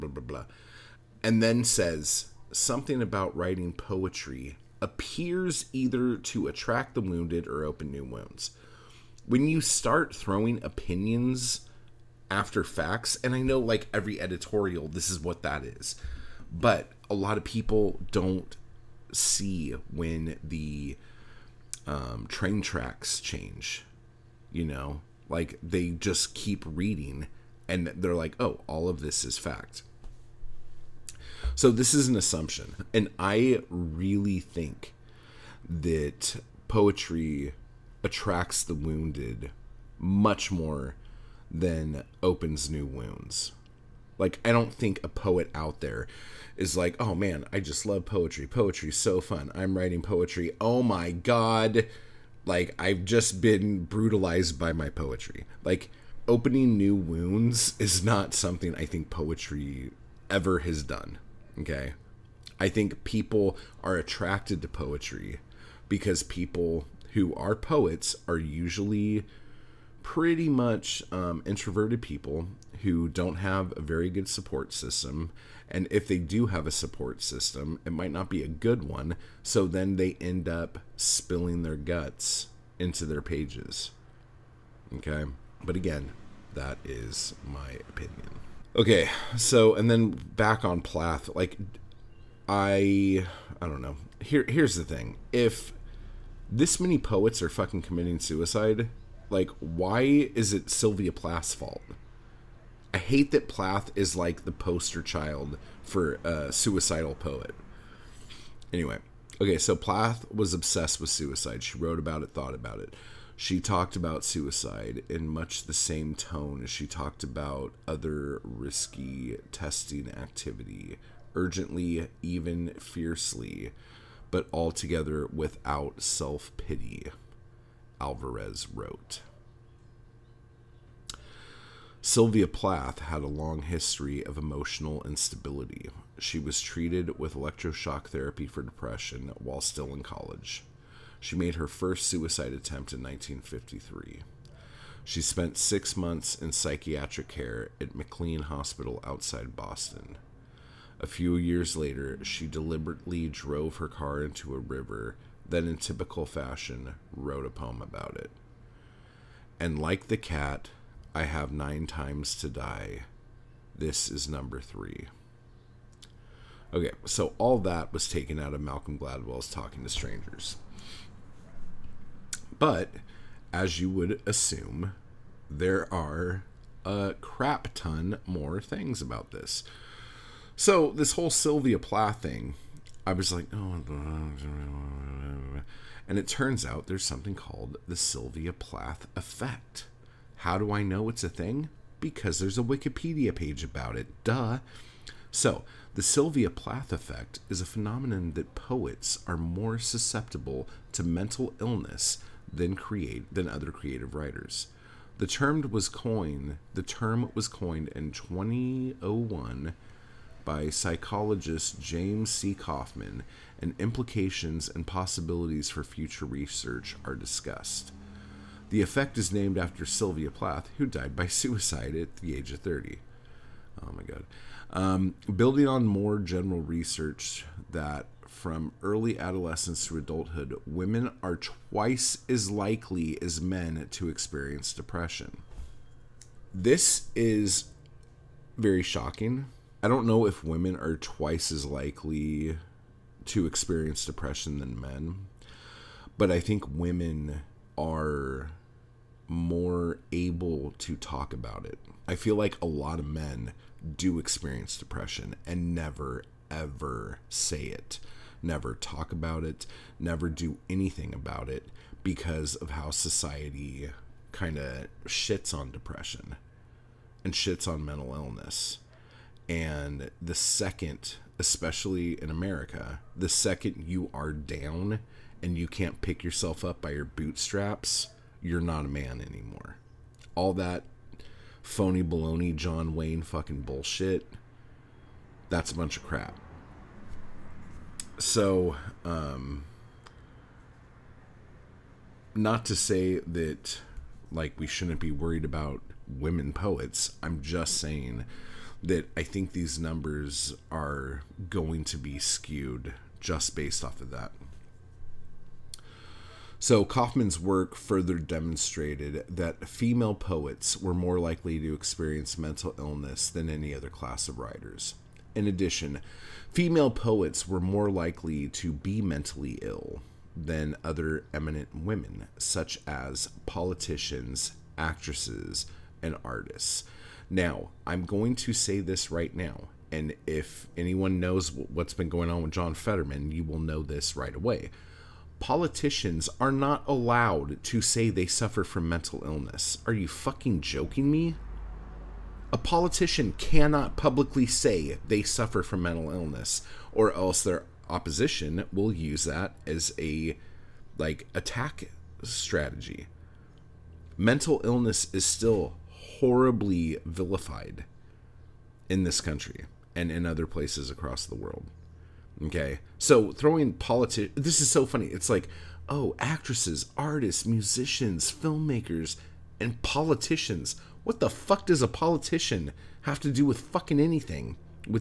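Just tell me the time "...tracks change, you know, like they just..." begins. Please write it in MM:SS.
00:22.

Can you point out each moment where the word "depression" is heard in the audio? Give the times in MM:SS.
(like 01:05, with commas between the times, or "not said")
02:18, 03:54, 04:04, 04:14, 04:25.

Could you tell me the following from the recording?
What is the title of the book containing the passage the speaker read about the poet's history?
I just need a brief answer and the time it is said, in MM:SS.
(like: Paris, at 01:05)
Talking to Strangers, at 02:49.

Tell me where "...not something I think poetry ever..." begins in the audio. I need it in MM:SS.
00:58.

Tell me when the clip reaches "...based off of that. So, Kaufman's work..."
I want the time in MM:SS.
05:03.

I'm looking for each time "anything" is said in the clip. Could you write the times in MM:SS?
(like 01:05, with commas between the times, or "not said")
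04:20, 06:13.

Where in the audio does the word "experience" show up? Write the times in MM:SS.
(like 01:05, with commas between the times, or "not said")
03:54, 04:03, 04:14, 05:11.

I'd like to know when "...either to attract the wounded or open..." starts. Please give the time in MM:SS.
00:05.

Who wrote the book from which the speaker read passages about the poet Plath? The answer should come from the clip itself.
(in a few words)
Malcolm Gladwell.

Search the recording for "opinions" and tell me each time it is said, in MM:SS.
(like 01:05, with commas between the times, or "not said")
00:10, 01:27.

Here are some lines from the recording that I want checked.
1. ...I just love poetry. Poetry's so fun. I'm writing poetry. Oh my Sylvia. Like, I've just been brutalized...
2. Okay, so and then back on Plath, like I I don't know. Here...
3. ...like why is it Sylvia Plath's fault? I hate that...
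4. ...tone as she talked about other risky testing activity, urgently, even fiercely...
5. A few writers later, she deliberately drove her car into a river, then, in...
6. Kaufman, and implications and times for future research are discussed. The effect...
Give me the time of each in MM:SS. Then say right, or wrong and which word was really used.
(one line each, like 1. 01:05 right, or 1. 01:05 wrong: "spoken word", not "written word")
1. 00:47 wrong: "God", not "Sylvia"
2. 01:28 right
3. 01:39 right
4. 01:56 right
5. 02:30 wrong: "years", not "writers"
6. 03:32 wrong: "possibilities", not "times".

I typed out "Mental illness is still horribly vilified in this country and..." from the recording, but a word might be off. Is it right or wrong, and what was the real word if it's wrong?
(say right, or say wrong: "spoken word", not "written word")
right.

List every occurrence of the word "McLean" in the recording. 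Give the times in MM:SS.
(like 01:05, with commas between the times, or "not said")
02:27.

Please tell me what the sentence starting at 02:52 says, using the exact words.
But as you would assume, there are a crap ton more things about this.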